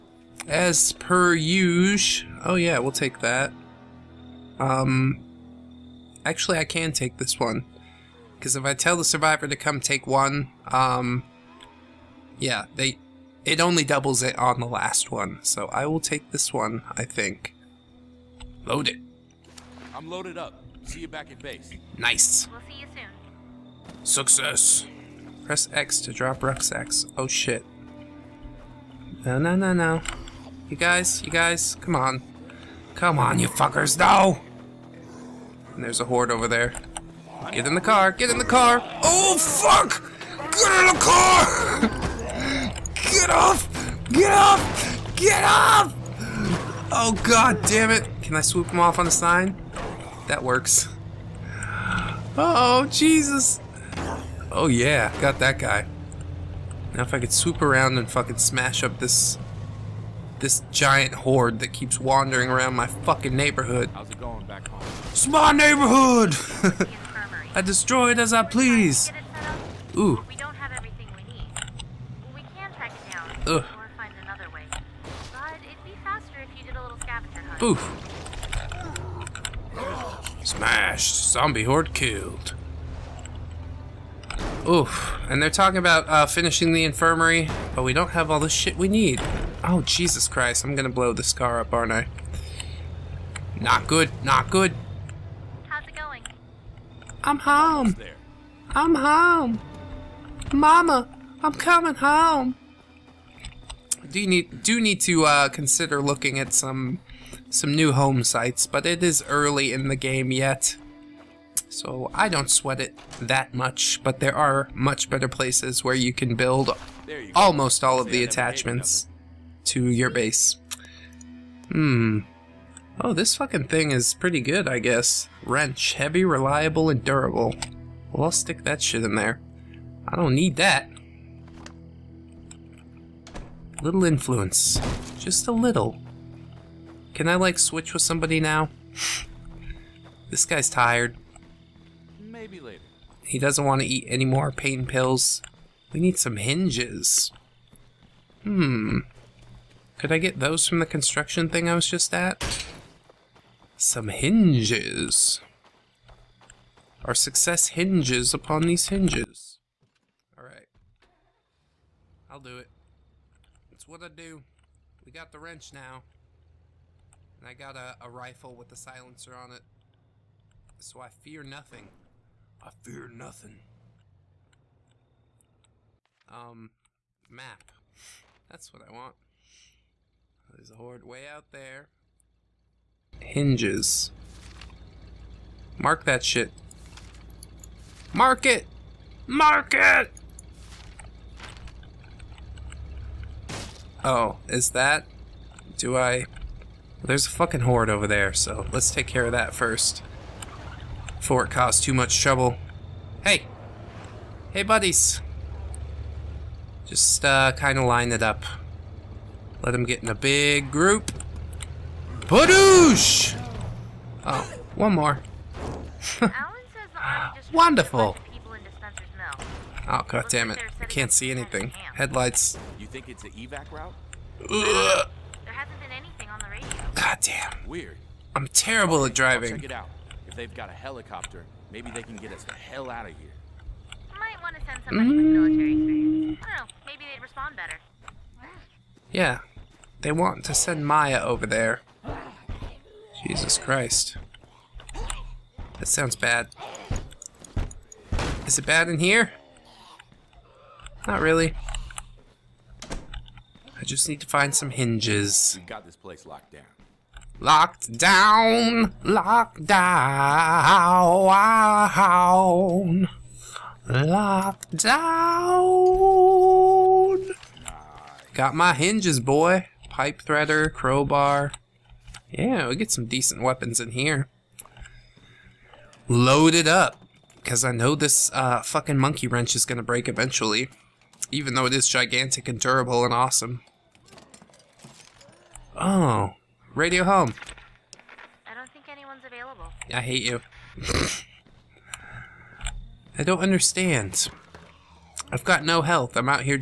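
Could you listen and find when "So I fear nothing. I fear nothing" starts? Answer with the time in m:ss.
2:50.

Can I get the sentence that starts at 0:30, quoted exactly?
You guys, you guys, come on.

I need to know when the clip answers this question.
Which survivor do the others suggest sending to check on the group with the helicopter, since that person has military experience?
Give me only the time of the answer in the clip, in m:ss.
4:00.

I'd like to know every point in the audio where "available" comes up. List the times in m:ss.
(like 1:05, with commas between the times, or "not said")
4:49.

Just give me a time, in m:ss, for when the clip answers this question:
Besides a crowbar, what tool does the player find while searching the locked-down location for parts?
4:29.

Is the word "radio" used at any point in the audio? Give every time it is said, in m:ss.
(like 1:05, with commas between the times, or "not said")
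3:46, 4:46.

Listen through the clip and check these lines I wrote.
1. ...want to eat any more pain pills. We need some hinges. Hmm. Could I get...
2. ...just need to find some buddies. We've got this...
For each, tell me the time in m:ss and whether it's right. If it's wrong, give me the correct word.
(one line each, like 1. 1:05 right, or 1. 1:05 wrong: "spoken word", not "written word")
1. 2:23 right
2. 4:13 wrong: "hinges", not "buddies".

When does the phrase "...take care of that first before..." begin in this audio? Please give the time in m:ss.
3:18.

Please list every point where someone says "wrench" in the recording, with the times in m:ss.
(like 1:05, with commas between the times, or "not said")
2:05, 2:45, 4:39.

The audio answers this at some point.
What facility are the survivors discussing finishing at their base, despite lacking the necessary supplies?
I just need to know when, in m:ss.
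1:26.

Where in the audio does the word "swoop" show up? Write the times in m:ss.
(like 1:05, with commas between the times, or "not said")
0:48, 0:57.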